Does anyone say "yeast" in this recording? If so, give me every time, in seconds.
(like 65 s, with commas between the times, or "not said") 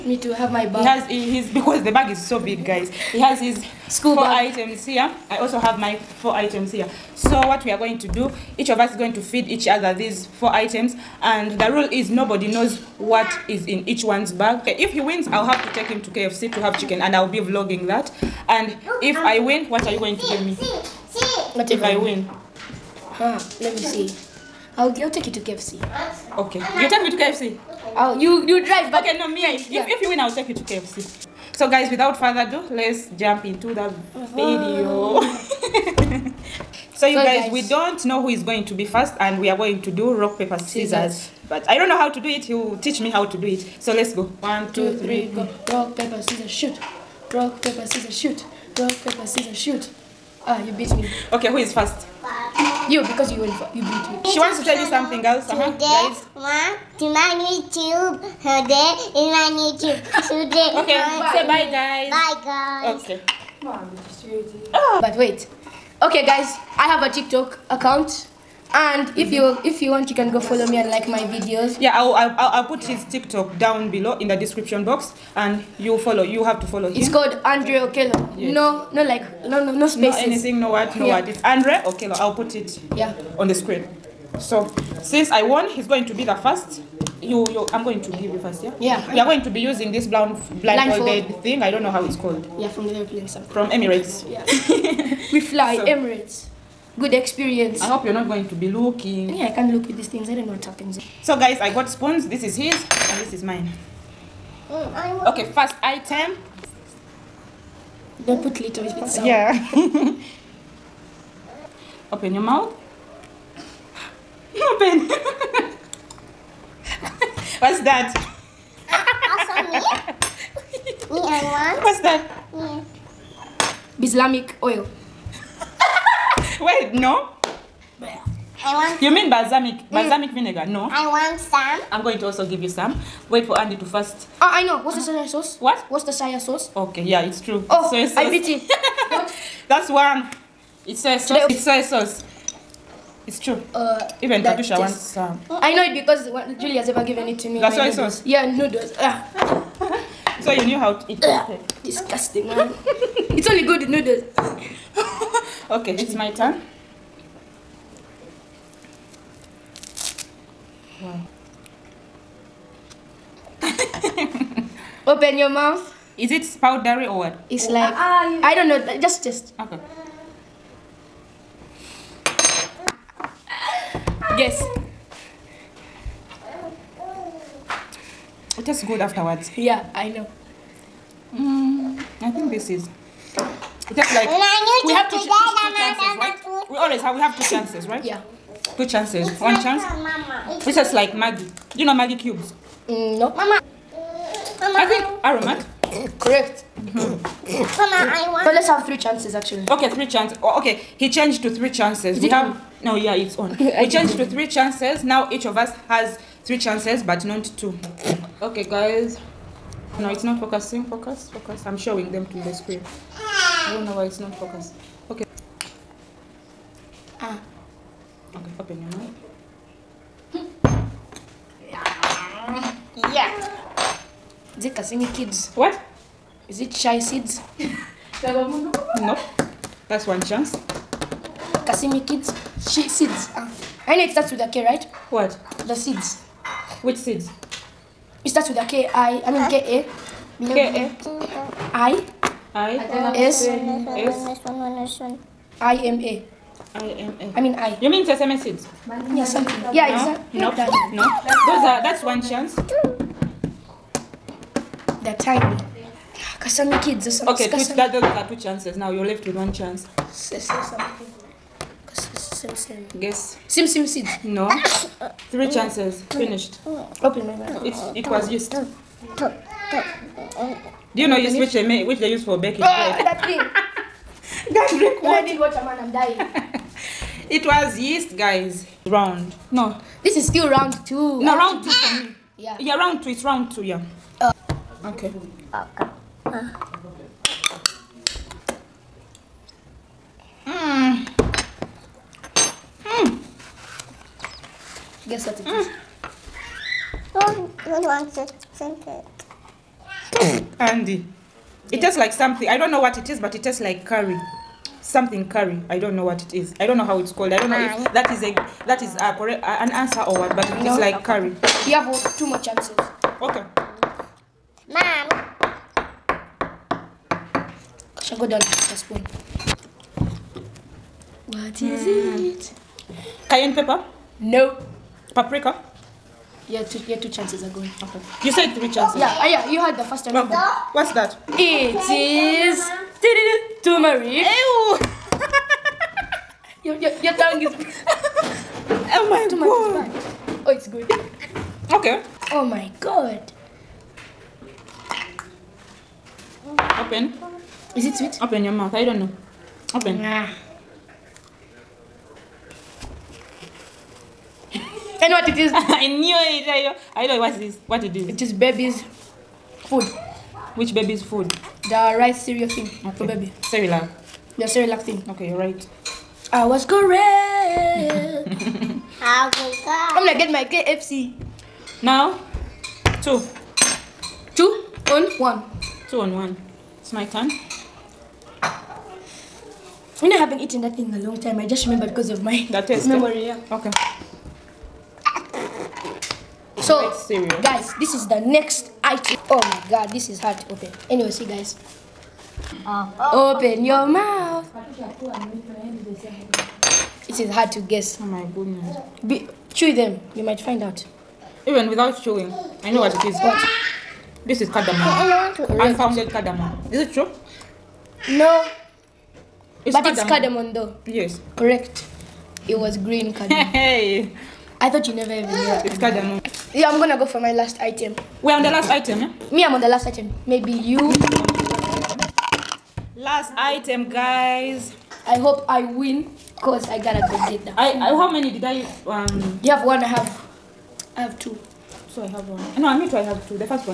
268 s, 277 s.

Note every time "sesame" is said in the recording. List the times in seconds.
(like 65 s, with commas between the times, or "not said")
248 s.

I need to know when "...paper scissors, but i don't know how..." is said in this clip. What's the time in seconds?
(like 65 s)
40 s.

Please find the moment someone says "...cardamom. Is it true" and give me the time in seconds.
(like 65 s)
406 s.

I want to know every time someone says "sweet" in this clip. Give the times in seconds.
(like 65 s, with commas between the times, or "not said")
347 s.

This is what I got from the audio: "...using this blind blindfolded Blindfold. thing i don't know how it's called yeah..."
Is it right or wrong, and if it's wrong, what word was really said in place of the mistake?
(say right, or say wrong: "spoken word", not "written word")
right.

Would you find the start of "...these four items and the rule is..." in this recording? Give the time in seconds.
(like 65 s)
9 s.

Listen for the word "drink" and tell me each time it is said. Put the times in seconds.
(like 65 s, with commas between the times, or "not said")
274 s, 298 s.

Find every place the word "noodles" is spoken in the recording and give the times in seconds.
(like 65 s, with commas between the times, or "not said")
148 s, 153 s.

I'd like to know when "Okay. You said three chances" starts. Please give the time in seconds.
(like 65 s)
327 s.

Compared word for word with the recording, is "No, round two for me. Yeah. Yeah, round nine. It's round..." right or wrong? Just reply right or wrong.
wrong.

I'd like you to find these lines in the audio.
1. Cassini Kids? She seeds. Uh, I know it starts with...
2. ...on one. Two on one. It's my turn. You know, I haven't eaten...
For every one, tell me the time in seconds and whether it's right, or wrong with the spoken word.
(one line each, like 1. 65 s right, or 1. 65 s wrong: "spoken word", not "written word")
1. 231 s right
2. 374 s right.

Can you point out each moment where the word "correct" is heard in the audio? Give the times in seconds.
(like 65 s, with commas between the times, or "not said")
196 s, 309 s, 366 s, 411 s.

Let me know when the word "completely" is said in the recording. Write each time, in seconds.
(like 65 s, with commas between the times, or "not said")
not said.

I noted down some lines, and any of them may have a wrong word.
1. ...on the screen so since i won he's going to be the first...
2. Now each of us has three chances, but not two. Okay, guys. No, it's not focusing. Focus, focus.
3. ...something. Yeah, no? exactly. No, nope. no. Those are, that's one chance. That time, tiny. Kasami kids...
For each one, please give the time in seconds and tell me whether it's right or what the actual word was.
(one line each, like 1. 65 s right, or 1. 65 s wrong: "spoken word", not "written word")
1. 83 s right
2. 205 s right
3. 249 s right.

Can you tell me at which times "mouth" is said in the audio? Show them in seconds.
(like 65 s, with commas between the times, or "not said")
112 s, 165 s, 267 s, 348 s, 393 s.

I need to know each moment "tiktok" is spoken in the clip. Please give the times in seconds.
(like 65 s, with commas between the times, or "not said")
67 s, 73 s.